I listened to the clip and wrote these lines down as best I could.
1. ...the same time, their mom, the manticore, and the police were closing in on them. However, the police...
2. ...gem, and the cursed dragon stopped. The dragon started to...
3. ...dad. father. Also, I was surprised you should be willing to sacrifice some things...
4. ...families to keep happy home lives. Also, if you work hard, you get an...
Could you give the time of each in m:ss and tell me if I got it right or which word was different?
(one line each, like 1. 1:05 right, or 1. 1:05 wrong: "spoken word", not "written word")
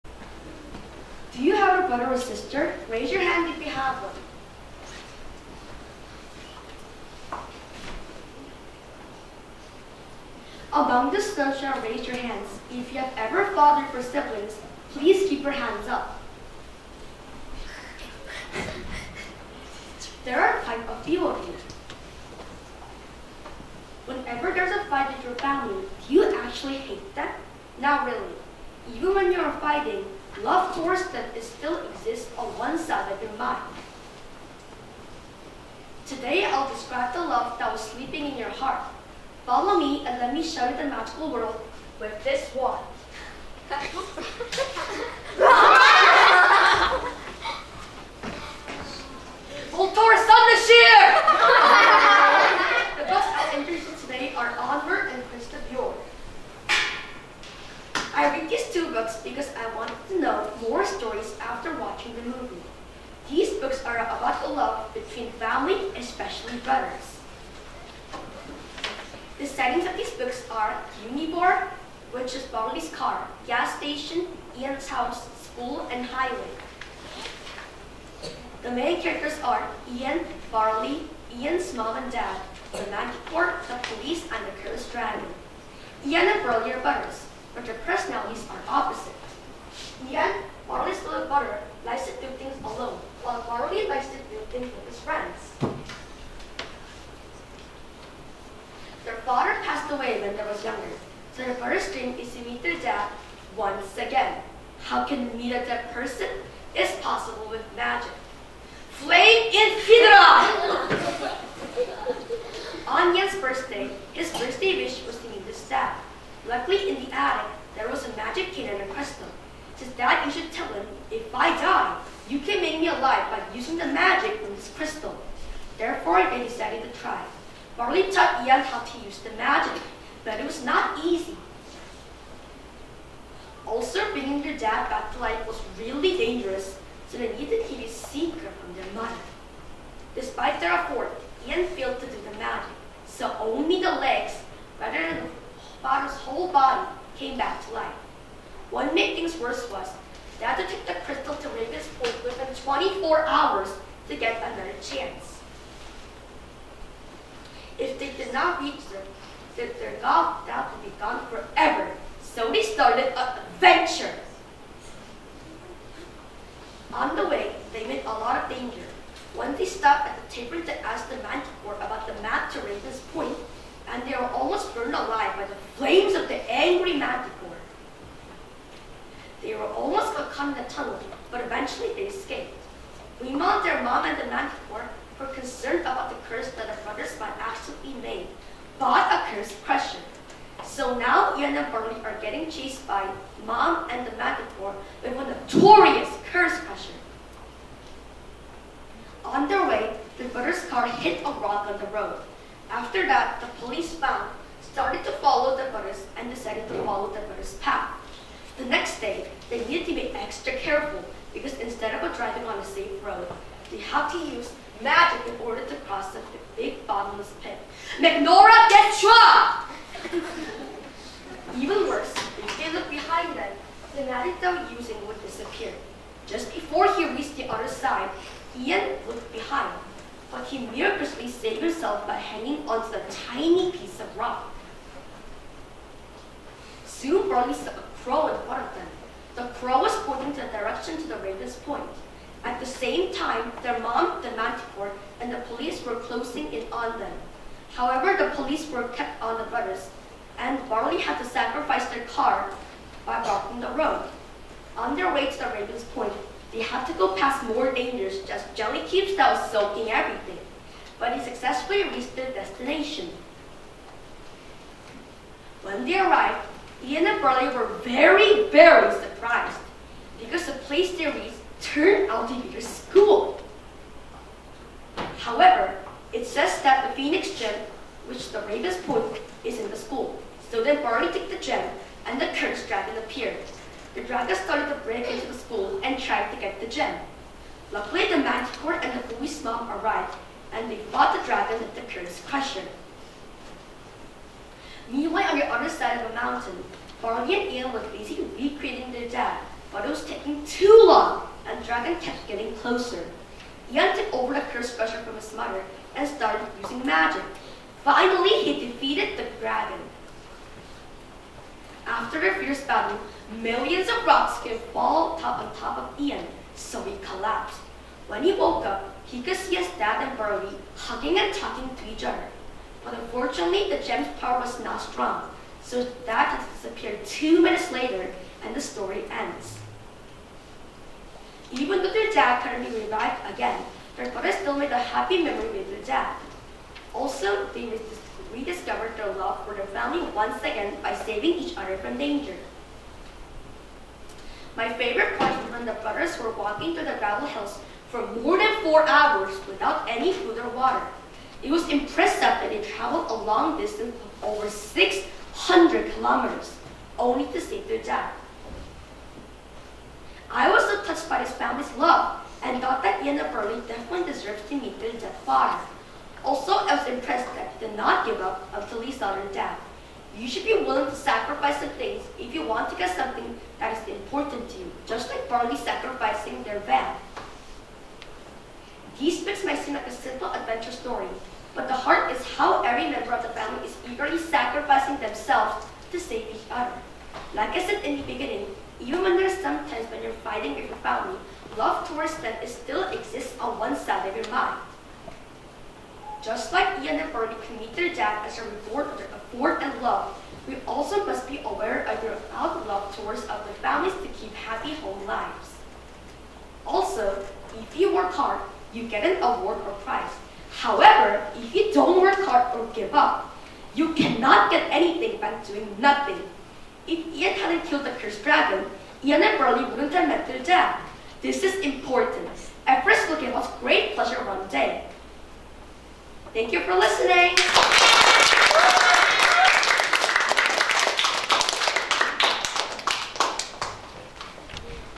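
1. 4:02 right
2. 4:41 wrong: "appeared", not "stopped"
3. 6:04 wrong: "impressed", not "surprised"
4. 6:43 right.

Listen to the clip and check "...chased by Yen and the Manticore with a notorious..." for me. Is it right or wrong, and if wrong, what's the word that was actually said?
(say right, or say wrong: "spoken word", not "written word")
wrong: "Mom", not "Yen".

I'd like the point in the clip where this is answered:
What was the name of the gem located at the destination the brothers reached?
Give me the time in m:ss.
4:36.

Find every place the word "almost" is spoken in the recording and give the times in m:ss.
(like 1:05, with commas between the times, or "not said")
2:54, 2:59.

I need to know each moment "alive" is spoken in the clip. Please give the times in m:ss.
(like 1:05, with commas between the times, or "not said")
2:02, 2:54.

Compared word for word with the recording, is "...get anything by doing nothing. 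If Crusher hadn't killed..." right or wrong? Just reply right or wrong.
wrong.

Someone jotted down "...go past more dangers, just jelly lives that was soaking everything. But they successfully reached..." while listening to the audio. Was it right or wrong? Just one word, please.
wrong.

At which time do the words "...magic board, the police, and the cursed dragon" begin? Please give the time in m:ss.
1:22.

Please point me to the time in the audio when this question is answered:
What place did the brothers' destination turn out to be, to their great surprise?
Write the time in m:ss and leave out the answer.
4:32.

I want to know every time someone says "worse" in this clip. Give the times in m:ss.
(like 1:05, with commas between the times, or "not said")
2:29, 3:41.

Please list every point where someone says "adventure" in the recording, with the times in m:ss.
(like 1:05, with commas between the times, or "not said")
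2:43, 6:20.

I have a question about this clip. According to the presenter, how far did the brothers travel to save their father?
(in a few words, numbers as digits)
over 600 kilometers.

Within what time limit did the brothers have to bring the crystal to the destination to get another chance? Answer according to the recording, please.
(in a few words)
24 hours.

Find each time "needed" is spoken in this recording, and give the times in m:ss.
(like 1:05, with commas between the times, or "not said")
2:17, 3:29.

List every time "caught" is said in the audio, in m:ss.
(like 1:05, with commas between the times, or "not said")
3:00.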